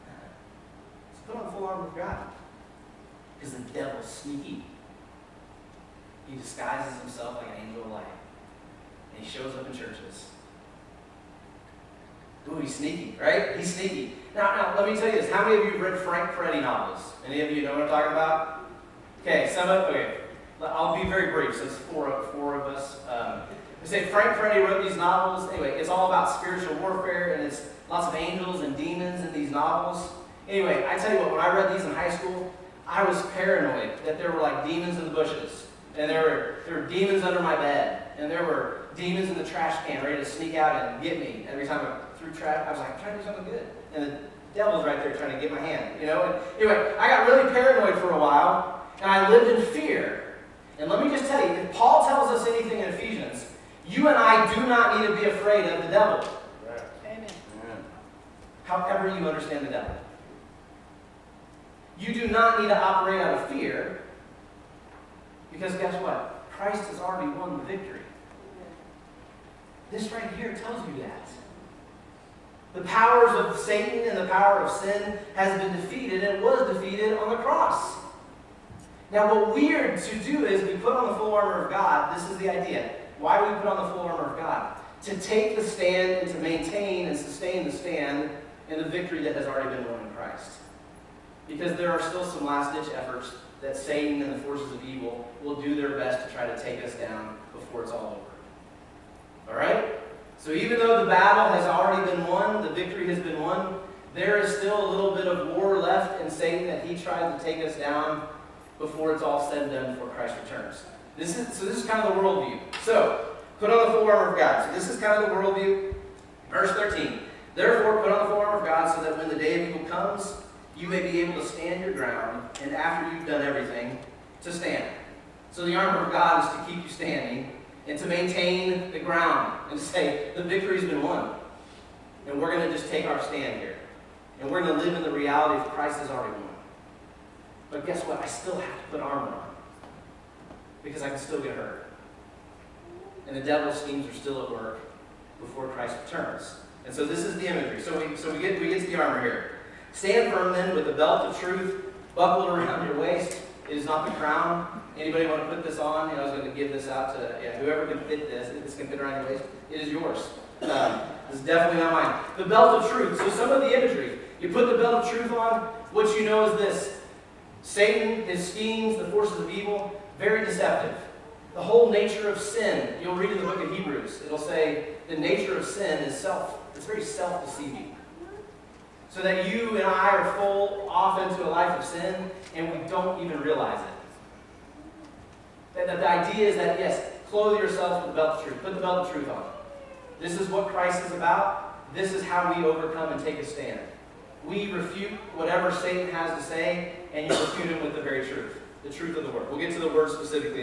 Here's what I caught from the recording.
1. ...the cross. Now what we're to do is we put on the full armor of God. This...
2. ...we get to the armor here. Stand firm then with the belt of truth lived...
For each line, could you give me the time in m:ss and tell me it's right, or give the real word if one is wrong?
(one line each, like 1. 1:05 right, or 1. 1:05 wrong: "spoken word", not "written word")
1. 1:17 right
2. 2:28 wrong: "buckled", not "lived".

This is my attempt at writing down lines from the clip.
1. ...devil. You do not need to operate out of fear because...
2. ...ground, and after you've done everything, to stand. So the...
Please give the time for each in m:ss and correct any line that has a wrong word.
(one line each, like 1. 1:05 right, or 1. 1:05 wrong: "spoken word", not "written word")
1. 0:59 right
2. 2:01 right.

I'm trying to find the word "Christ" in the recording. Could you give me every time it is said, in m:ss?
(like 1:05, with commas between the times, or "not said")
1:06, 1:30, 1:50, 2:15, 2:25, 3:10.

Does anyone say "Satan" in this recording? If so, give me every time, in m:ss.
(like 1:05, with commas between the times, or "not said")
1:13, 1:33, 1:46, 2:47, 3:15.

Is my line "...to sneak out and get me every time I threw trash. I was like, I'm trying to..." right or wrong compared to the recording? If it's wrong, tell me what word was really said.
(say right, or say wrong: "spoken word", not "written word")
right.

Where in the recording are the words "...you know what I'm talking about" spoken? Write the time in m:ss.
0:17.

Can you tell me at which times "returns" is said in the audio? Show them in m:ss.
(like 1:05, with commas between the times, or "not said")
1:50, 2:26.